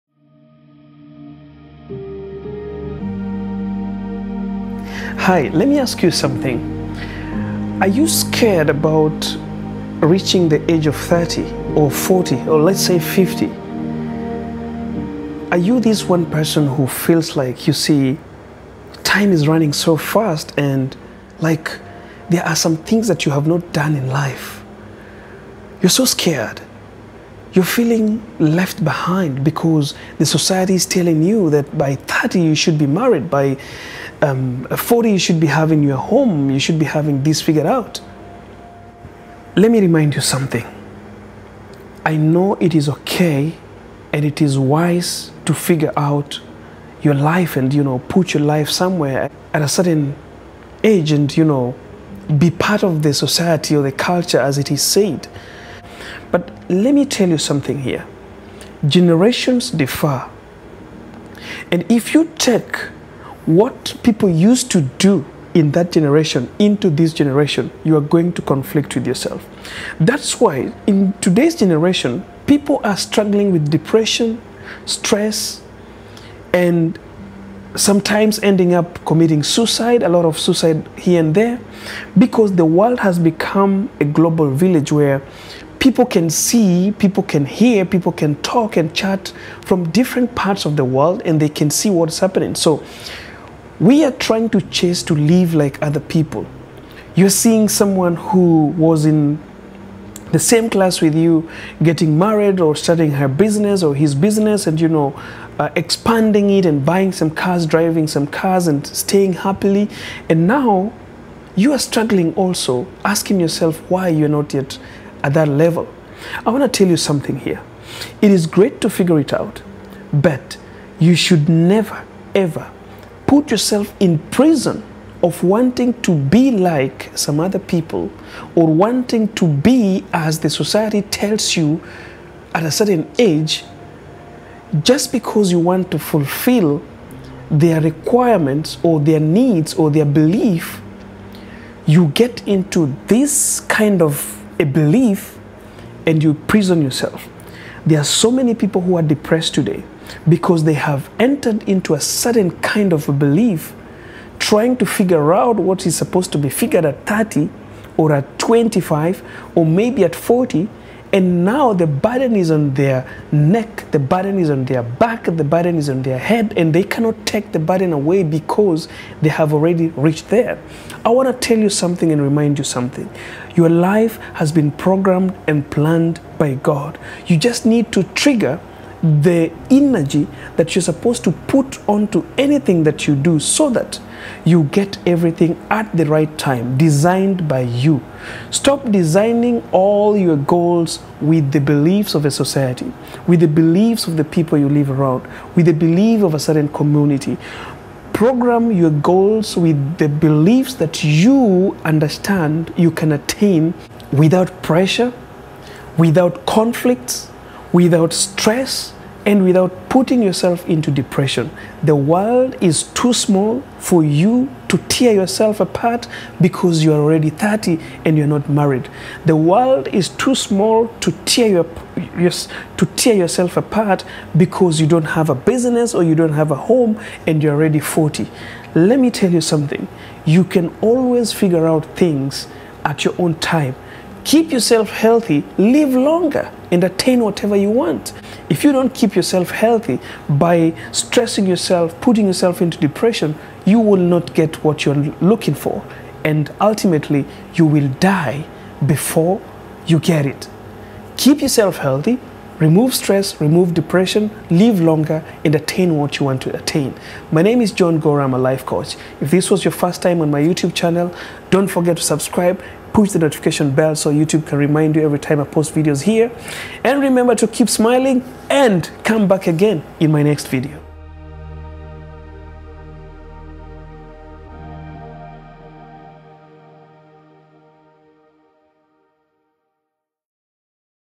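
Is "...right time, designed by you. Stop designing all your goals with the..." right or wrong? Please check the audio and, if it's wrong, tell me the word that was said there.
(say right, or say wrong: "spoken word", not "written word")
right.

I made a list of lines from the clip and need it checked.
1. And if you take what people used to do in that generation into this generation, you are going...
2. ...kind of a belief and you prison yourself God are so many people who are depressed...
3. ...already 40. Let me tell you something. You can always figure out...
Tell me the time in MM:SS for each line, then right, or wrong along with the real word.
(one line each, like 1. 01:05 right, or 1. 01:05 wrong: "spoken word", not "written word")
1. 01:01 right
2. 02:23 wrong: "There", not "God"
3. 03:47 right.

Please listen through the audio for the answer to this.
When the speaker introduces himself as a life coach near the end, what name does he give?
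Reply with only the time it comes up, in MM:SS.
04:17.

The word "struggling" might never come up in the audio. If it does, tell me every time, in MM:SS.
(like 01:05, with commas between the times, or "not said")
01:12, 01:51.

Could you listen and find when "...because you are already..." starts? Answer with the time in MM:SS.
03:36.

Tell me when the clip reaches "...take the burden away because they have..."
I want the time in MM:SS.
02:47.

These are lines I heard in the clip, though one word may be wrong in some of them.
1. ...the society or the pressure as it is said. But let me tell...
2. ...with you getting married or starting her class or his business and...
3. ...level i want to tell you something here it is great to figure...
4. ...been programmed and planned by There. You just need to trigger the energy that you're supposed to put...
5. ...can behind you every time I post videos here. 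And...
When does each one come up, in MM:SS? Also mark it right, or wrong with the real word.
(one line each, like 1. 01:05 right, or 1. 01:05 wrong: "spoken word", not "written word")
1. 00:53 wrong: "culture", not "pressure"
2. 01:41 wrong: "business", not "class"
3. 01:55 right
4. 02:54 wrong: "God", not "There"
5. 04:24 wrong: "remind", not "behind".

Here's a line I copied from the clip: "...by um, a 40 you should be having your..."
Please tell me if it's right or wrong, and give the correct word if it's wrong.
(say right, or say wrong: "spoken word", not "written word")
right.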